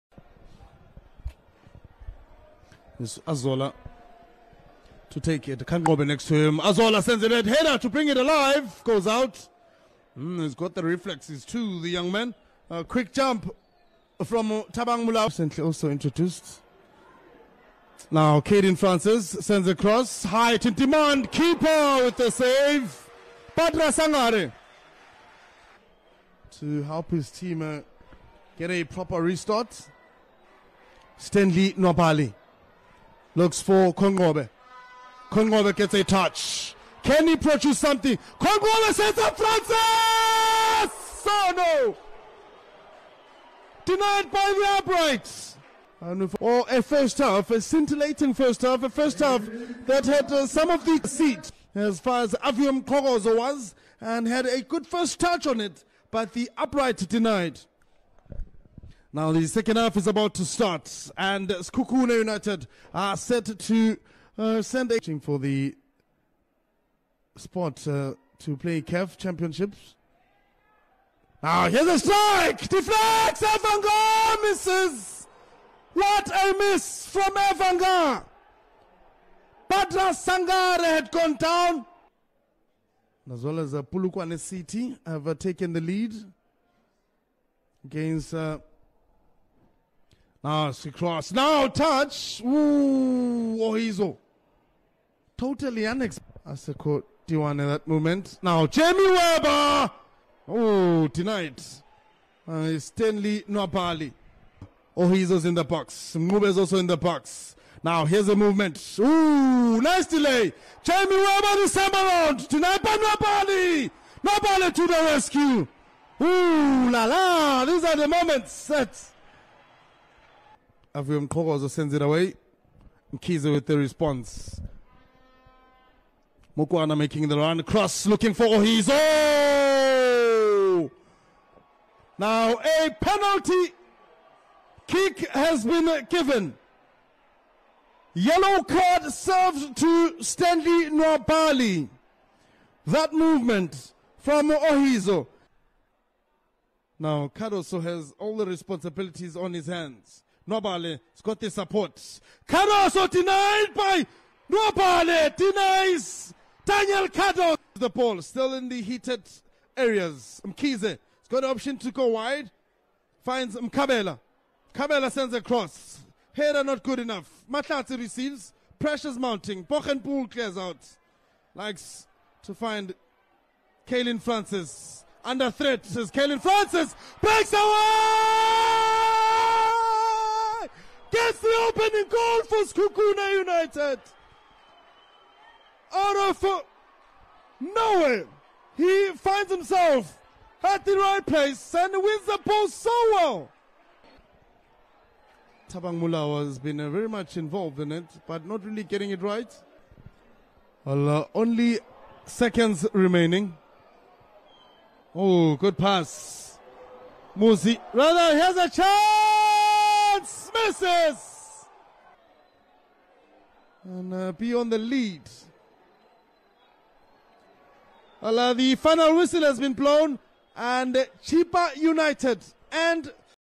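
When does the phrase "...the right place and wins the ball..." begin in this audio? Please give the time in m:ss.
3:10.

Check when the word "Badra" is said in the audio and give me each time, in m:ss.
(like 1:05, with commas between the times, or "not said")
0:23, 1:19.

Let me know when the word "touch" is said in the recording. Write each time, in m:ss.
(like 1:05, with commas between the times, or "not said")
0:36, 0:55, 1:31.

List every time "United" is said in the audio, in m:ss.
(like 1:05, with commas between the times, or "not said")
1:02, 3:03, 3:41.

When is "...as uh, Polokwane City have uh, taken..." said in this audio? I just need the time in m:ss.
1:23.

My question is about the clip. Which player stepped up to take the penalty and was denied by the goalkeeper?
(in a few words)
Daniel Cardoso.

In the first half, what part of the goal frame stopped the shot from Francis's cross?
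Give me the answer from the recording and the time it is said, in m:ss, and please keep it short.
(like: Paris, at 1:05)
The uprights, at 0:44.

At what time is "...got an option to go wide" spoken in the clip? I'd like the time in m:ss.
2:41.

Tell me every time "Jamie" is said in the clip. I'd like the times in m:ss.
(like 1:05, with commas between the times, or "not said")
1:38, 1:50.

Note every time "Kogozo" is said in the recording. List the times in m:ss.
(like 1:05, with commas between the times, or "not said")
0:52, 2:01.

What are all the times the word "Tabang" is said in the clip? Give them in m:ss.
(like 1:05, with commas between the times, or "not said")
0:14, 3:15.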